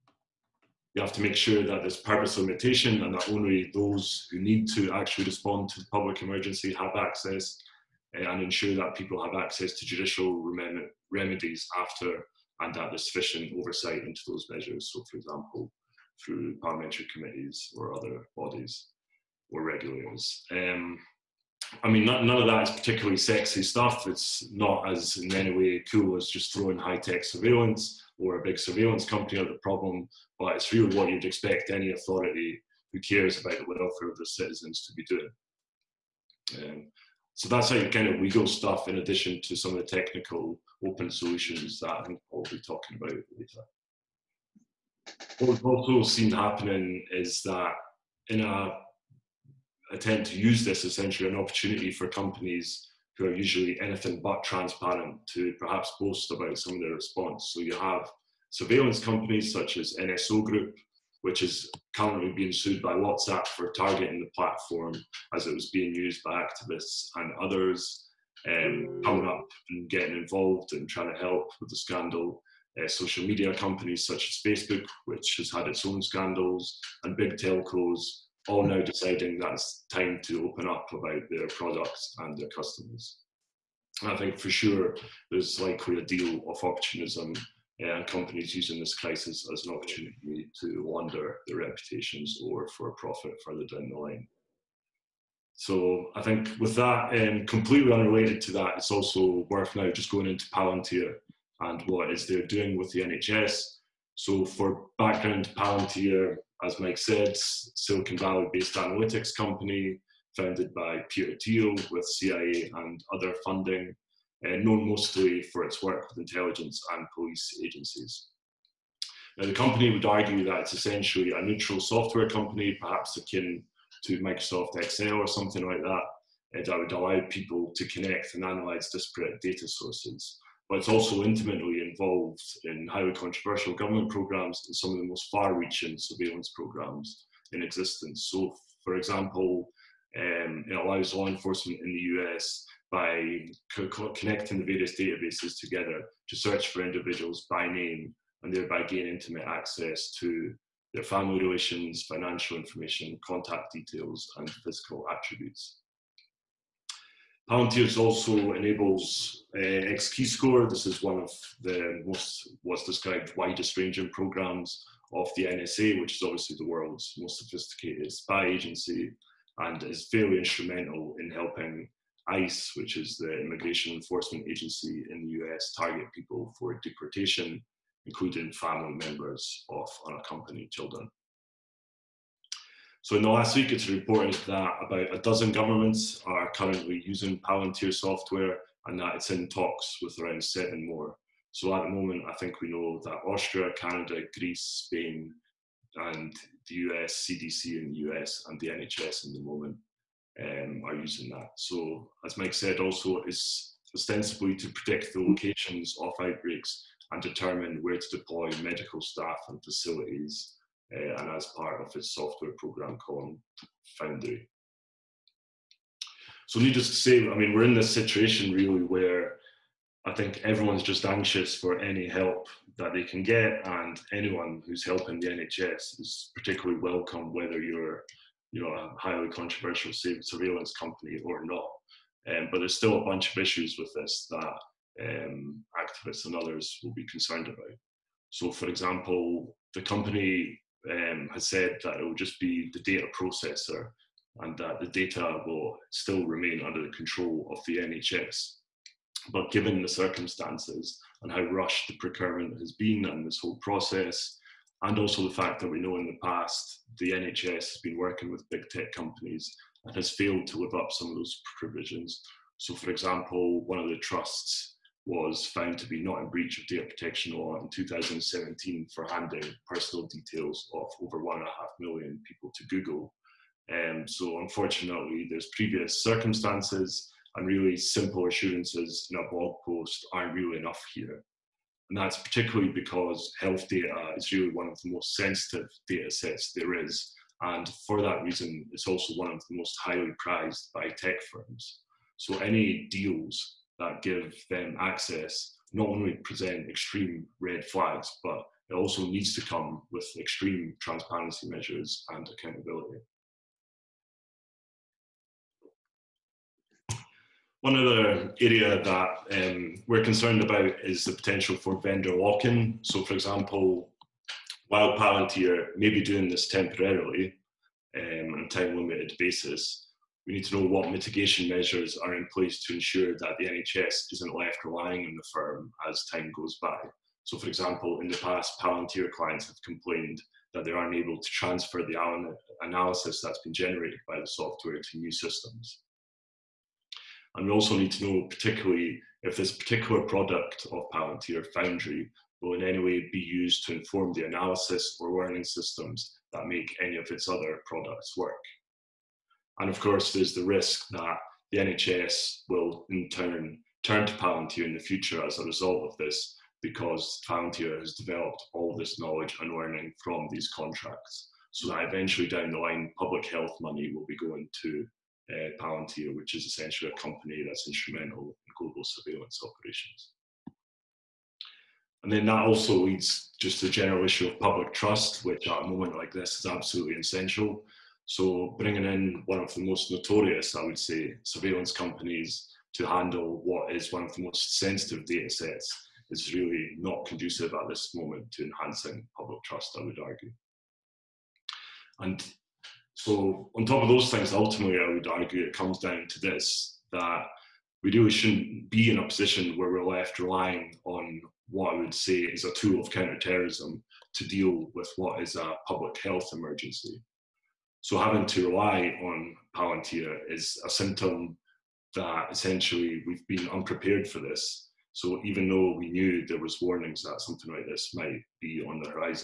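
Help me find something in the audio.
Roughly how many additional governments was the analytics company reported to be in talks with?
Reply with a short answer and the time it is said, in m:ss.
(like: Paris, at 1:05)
7, at 3:10.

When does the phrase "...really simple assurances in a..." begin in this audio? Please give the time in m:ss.
4:37.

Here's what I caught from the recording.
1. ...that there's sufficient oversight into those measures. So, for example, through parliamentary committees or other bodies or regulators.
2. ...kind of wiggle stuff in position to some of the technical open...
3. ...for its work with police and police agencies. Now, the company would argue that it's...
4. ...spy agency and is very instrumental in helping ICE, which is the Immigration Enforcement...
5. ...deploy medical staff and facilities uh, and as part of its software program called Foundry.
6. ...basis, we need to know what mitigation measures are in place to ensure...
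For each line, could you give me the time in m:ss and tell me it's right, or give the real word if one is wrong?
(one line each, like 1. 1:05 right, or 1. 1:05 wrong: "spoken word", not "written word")
1. 0:12 right
2. 0:37 wrong: "addition", not "position"
3. 1:55 wrong: "intelligence", not "police"
4. 2:48 right
5. 3:28 right
6. 5:19 right.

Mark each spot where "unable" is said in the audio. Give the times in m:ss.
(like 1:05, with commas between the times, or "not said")
5:30.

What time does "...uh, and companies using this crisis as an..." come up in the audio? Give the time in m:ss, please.
1:27.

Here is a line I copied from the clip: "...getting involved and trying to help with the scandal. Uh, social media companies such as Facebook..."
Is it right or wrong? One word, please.
right.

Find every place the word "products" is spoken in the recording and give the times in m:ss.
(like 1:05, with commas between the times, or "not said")
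1:21, 5:40, 5:47.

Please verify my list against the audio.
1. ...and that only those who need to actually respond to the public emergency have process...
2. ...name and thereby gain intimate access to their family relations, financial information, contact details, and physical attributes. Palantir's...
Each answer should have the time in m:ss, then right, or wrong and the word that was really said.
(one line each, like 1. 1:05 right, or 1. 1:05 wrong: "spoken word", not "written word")
1. 0:03 wrong: "access", not "process"
2. 2:27 right.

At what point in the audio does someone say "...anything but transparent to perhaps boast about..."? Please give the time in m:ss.
0:53.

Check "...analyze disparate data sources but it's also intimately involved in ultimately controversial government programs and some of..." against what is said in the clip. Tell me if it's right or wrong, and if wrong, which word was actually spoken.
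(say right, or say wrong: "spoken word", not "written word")
wrong: "highly", not "ultimately".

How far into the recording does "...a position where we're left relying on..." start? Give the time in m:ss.
6:38.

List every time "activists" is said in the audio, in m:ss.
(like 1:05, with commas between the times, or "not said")
1:06, 3:55.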